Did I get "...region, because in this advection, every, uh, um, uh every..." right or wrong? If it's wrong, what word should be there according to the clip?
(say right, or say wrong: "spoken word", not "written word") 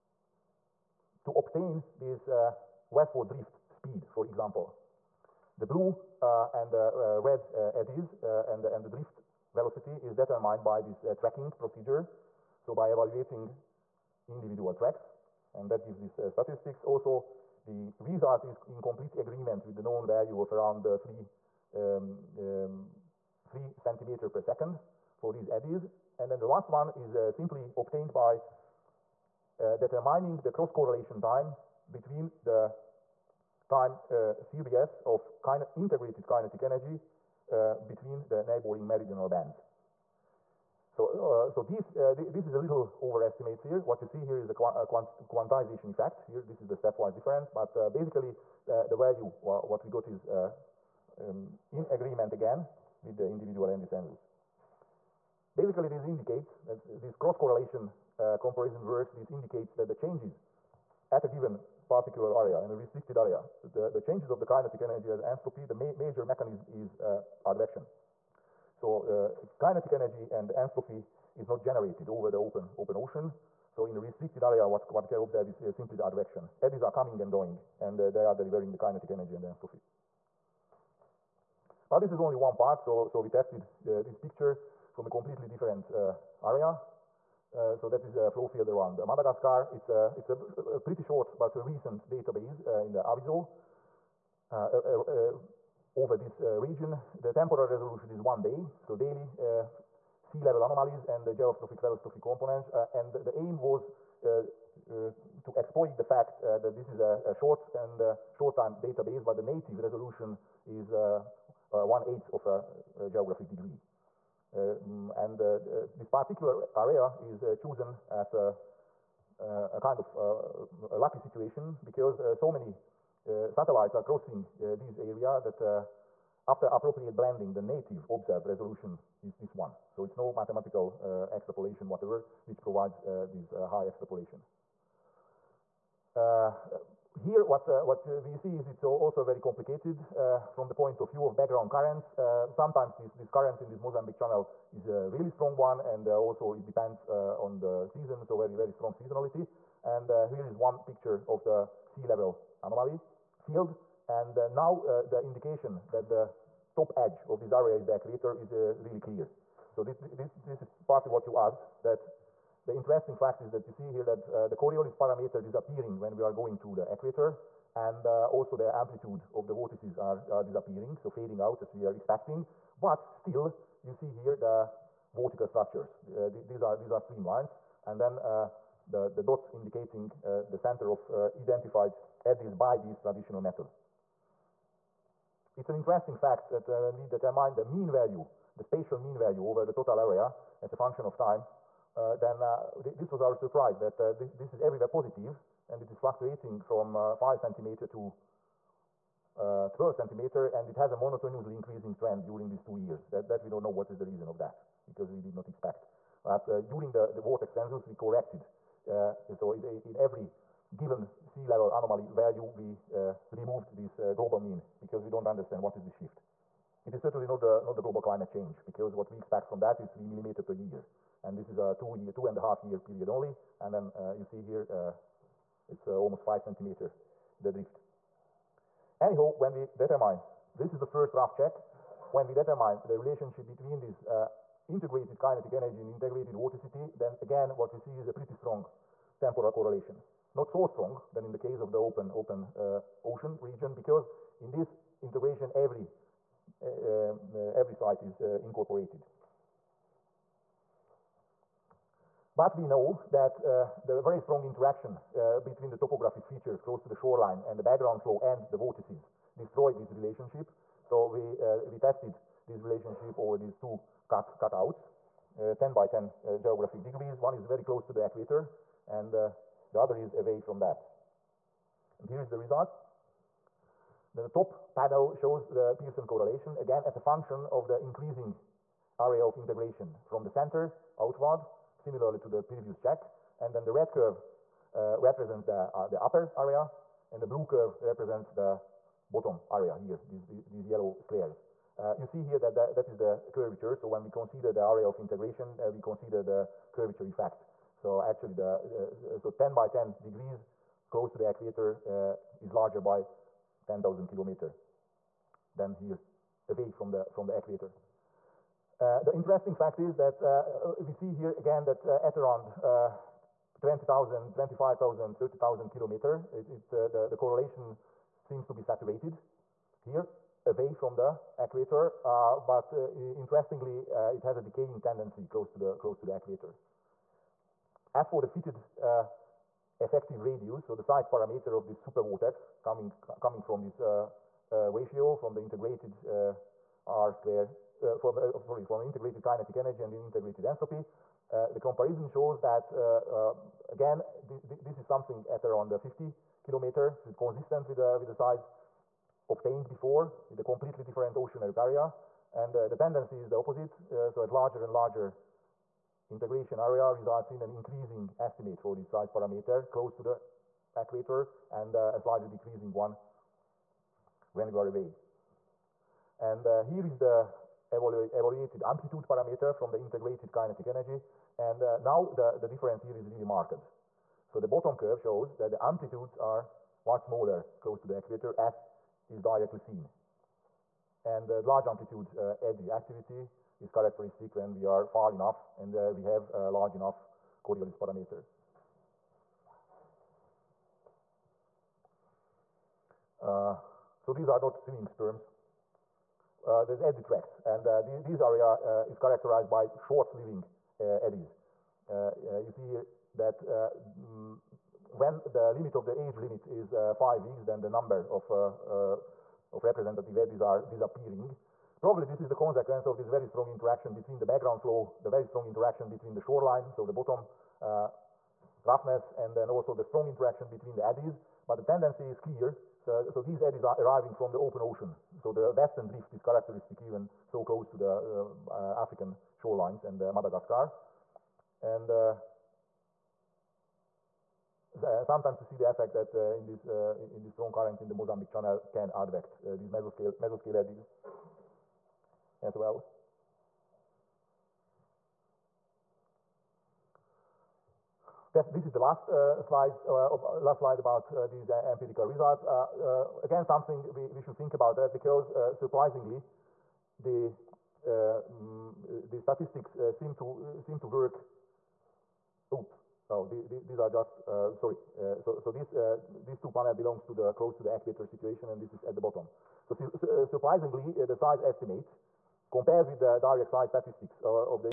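wrong: "integration", not "advection".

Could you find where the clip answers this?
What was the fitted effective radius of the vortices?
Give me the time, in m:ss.
5:45.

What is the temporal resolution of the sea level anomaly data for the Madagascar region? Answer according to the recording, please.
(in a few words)
one day.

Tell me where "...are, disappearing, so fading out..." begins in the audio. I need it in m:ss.
2:50.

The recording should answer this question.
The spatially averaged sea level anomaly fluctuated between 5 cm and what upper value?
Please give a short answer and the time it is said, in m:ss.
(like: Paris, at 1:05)
12 cm, at 3:19.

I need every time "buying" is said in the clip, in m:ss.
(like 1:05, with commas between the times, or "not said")
not said.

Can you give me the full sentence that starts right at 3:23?
That, that we don't know what is the reason of that because we did not expect.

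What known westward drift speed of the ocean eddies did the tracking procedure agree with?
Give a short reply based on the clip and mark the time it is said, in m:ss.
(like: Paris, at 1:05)
3 cm per second, at 0:23.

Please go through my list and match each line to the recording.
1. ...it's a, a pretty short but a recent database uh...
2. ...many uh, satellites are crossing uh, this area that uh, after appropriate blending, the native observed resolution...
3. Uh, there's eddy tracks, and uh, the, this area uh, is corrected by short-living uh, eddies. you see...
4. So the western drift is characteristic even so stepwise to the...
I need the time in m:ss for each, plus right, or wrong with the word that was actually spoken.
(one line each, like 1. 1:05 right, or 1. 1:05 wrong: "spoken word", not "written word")
1. 1:30 right
2. 2:02 right
3. 6:36 wrong: "characterized", not "corrected"
4. 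7:05 wrong: "close", not "stepwise".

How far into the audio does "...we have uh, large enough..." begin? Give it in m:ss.
6:25.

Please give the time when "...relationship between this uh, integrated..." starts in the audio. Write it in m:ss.
3:52.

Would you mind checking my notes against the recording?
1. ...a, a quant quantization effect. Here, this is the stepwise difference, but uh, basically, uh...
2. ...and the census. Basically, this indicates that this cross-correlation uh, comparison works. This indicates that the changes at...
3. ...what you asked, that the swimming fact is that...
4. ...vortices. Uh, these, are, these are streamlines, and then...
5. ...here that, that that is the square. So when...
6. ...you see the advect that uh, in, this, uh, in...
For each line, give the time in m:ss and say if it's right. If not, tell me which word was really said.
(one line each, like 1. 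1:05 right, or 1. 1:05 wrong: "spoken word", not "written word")
1. 0:44 right
2. 0:53 right
3. 2:41 wrong: "interesting", not "swimming"
4. 2:55 wrong: "structures", not "vortices"
5. 4:52 wrong: "curvature", not "square"
6. 7:15 wrong: "effect", not "advect".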